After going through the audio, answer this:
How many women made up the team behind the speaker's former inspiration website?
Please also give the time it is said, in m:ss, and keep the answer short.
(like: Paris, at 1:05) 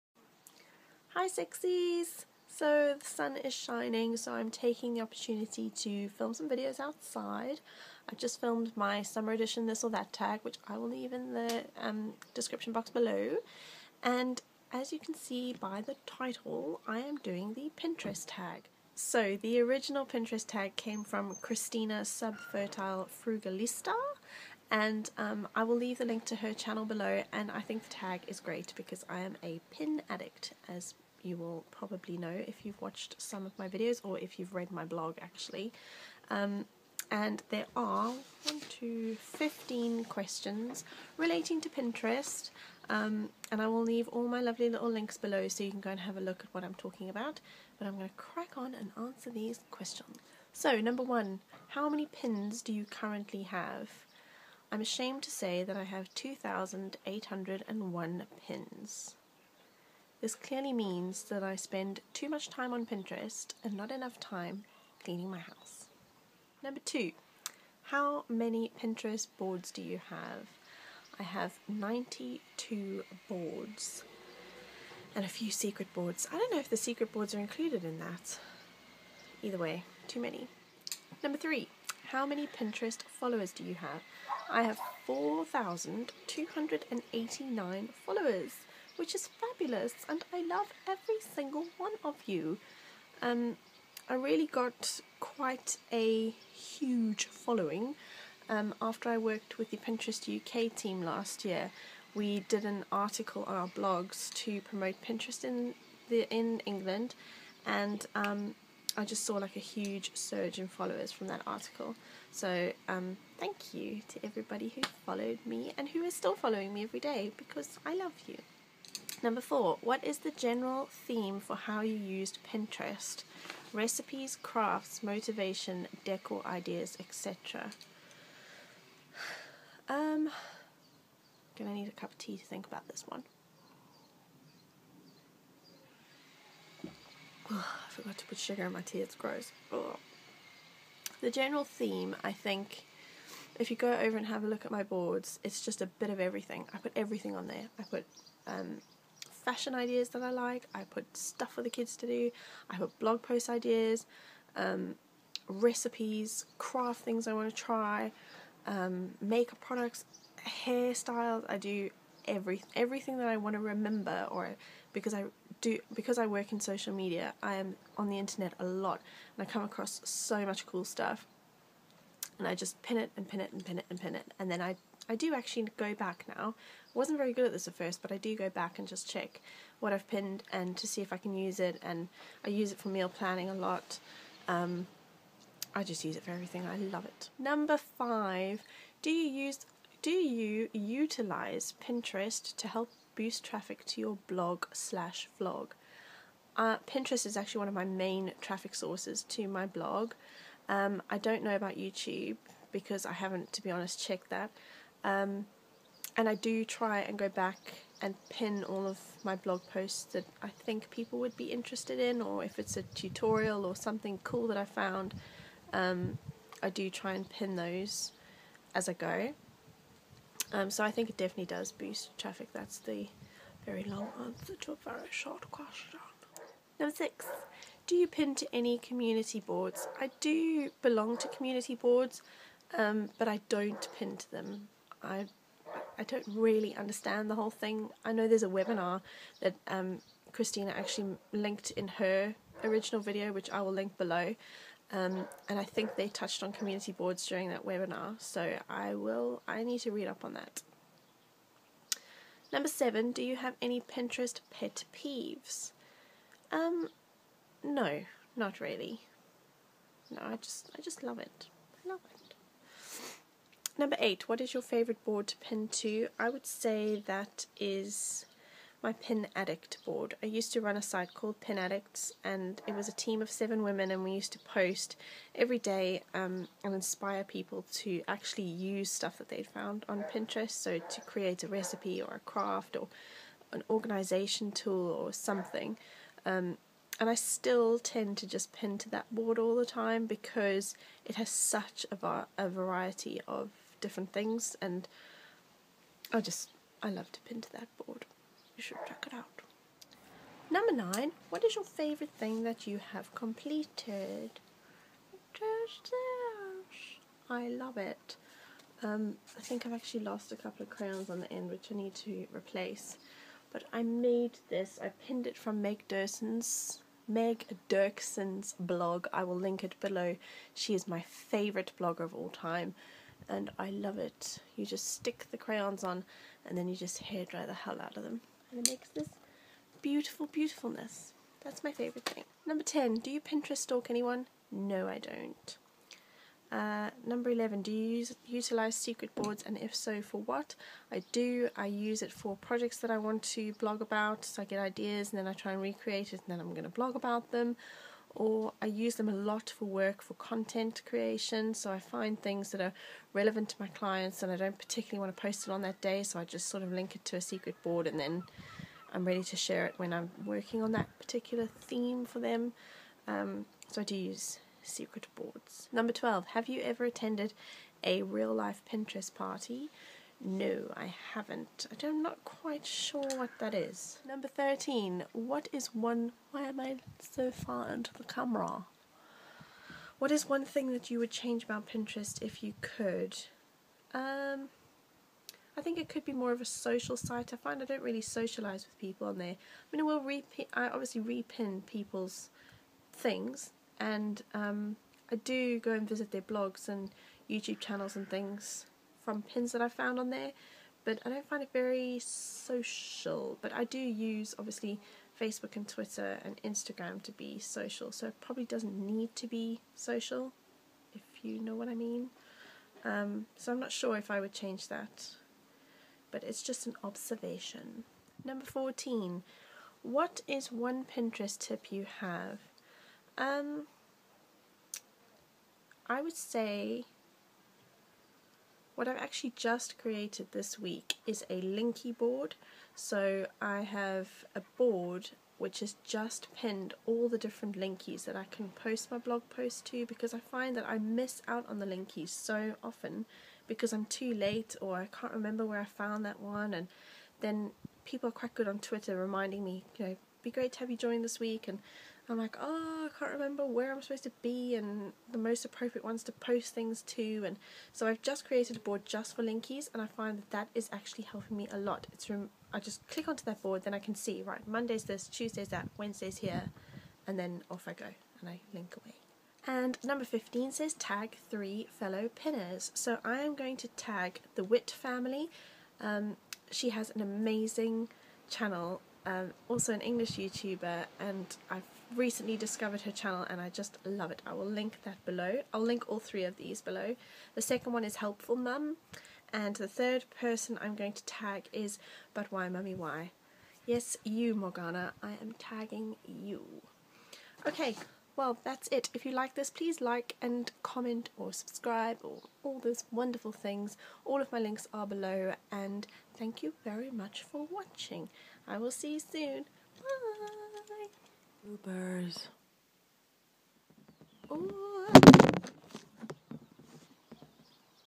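7, at 4:33.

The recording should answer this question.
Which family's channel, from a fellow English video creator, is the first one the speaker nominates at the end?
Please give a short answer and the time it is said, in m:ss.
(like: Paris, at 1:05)
The Witt family, at 7:54.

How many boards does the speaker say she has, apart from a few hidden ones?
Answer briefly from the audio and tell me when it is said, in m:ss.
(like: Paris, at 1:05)
92, at 1:11.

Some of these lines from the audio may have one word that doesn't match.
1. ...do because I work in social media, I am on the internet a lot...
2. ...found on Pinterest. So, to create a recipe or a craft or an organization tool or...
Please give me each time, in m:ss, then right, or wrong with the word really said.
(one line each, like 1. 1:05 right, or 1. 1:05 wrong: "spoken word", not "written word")
1. 2:45 right
2. 4:39 right.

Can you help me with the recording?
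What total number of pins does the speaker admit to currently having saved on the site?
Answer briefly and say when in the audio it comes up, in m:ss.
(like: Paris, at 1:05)
2,801, at 0:56.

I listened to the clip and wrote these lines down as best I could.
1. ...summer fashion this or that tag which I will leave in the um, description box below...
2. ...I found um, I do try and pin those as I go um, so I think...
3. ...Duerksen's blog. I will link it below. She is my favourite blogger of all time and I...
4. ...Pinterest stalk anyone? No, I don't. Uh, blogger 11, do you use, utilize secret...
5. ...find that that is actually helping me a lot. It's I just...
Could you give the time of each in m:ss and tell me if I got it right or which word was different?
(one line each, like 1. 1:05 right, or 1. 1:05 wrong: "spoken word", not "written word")
1. 0:09 wrong: "edition", not "fashion"
2. 3:34 right
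3. 5:17 right
4. 5:33 wrong: "number", not "blogger"
5. 7:39 right.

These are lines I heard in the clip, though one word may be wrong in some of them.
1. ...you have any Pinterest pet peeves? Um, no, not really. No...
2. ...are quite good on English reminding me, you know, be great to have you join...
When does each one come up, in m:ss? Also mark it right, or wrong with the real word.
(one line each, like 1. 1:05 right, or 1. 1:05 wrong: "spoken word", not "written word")
1. 4:13 right
2. 7:28 wrong: "Twitter", not "English".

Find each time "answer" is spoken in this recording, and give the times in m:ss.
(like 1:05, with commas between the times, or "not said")
0:48, 3:44.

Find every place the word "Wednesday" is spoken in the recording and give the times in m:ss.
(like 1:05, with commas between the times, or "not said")
7:45.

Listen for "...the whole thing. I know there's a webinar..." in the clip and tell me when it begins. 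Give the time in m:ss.
3:57.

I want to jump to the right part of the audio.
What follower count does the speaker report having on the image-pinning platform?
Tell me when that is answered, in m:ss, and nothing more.
1:25.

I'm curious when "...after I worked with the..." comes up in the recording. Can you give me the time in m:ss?
1:38.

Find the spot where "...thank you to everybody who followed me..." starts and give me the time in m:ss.
1:53.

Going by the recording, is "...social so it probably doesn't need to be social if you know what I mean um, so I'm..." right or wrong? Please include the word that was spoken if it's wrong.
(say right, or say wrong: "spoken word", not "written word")
right.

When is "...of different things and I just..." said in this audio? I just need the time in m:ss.
4:53.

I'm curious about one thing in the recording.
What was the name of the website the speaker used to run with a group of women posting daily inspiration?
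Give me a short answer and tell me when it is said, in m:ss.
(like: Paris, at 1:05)
Pin Addicts, at 4:31.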